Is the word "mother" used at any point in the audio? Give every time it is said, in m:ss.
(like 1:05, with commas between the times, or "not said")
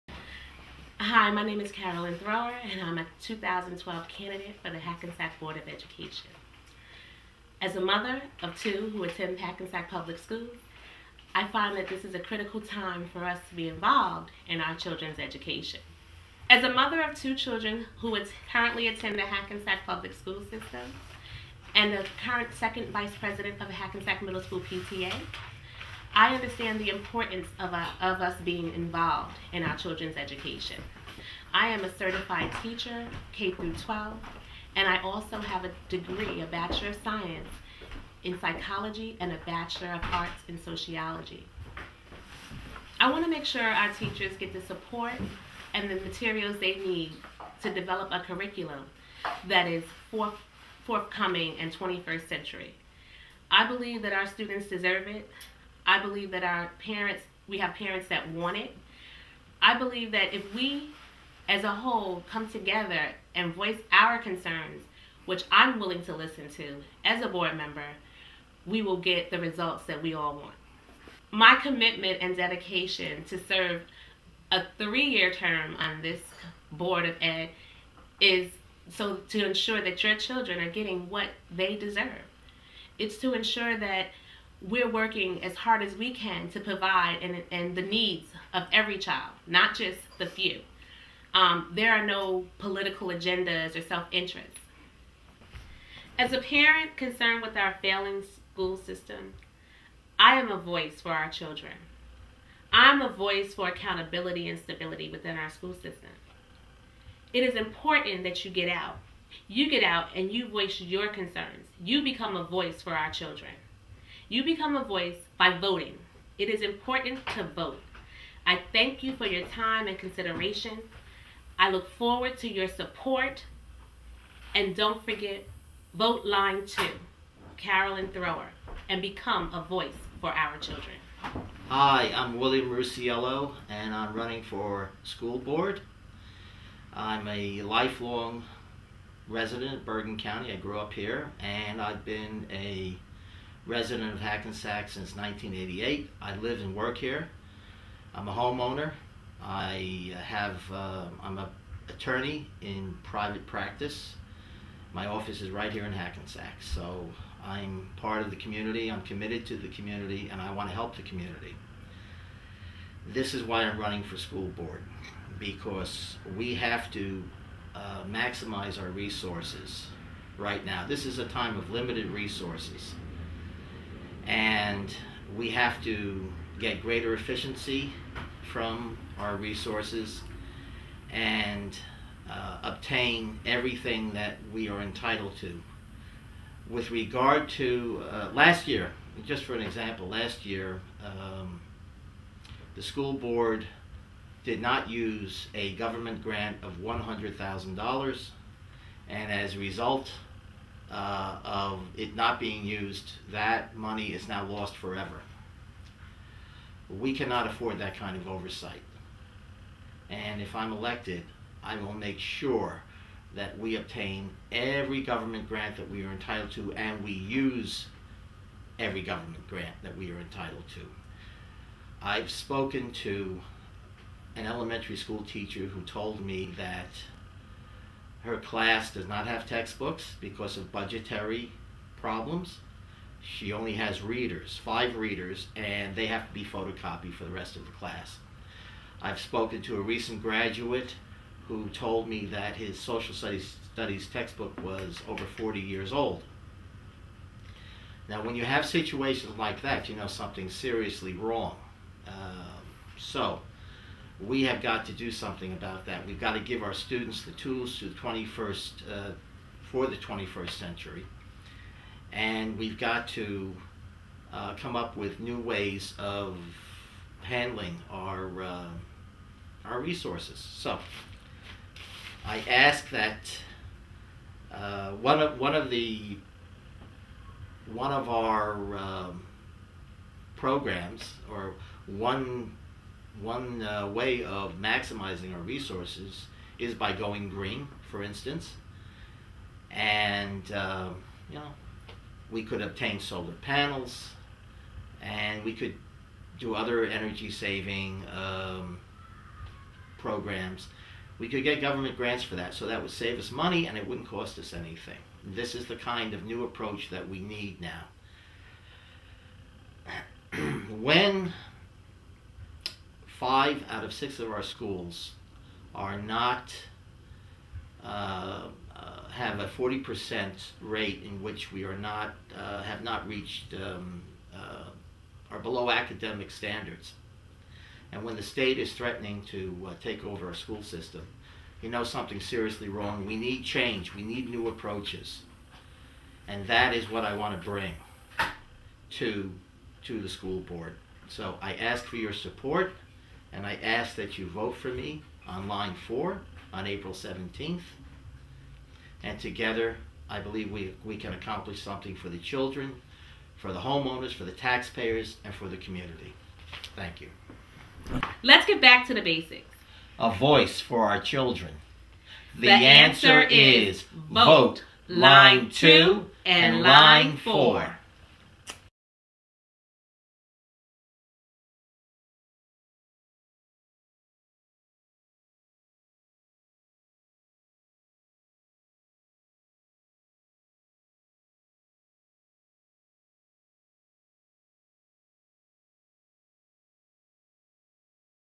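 0:07, 0:16.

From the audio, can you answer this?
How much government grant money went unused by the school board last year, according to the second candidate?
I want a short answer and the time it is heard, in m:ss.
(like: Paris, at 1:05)
$100,000, at 3:16.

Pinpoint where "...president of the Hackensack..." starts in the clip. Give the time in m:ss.
0:23.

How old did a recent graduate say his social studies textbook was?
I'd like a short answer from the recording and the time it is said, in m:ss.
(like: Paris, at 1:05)
Over 40 years, at 4:05.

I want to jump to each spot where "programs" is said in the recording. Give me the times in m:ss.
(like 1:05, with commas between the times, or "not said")
4:40, 4:59.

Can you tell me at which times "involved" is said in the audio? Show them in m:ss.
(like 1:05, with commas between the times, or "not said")
0:13, 0:28.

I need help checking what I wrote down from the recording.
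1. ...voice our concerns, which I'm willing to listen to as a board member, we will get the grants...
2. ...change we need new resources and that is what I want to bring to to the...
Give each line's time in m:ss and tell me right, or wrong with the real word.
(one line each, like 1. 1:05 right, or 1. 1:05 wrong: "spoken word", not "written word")
1. 1:03 wrong: "results", not "grants"
2. 5:33 wrong: "approaches", not "resources".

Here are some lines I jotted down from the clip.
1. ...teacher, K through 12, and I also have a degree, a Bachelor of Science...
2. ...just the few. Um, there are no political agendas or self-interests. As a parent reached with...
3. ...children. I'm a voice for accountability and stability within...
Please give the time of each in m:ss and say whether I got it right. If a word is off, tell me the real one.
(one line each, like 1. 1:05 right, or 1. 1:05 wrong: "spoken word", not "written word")
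1. 0:32 right
2. 1:29 wrong: "concerned", not "reached"
3. 1:41 right.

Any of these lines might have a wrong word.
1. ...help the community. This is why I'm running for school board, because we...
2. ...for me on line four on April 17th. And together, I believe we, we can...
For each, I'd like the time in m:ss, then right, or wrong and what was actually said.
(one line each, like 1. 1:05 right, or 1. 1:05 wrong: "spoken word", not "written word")
1. 2:40 right
2. 5:44 right.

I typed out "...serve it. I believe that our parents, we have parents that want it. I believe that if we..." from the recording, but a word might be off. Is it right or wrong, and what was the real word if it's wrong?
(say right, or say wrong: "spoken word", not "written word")
wrong: "deserve", not "serve".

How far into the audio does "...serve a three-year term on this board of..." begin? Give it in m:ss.
1:13.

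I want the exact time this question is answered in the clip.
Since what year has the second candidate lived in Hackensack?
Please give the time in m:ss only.
2:25.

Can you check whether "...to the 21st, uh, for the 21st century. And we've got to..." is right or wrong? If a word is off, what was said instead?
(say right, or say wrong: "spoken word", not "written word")
right.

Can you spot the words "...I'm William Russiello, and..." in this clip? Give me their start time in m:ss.
2:12.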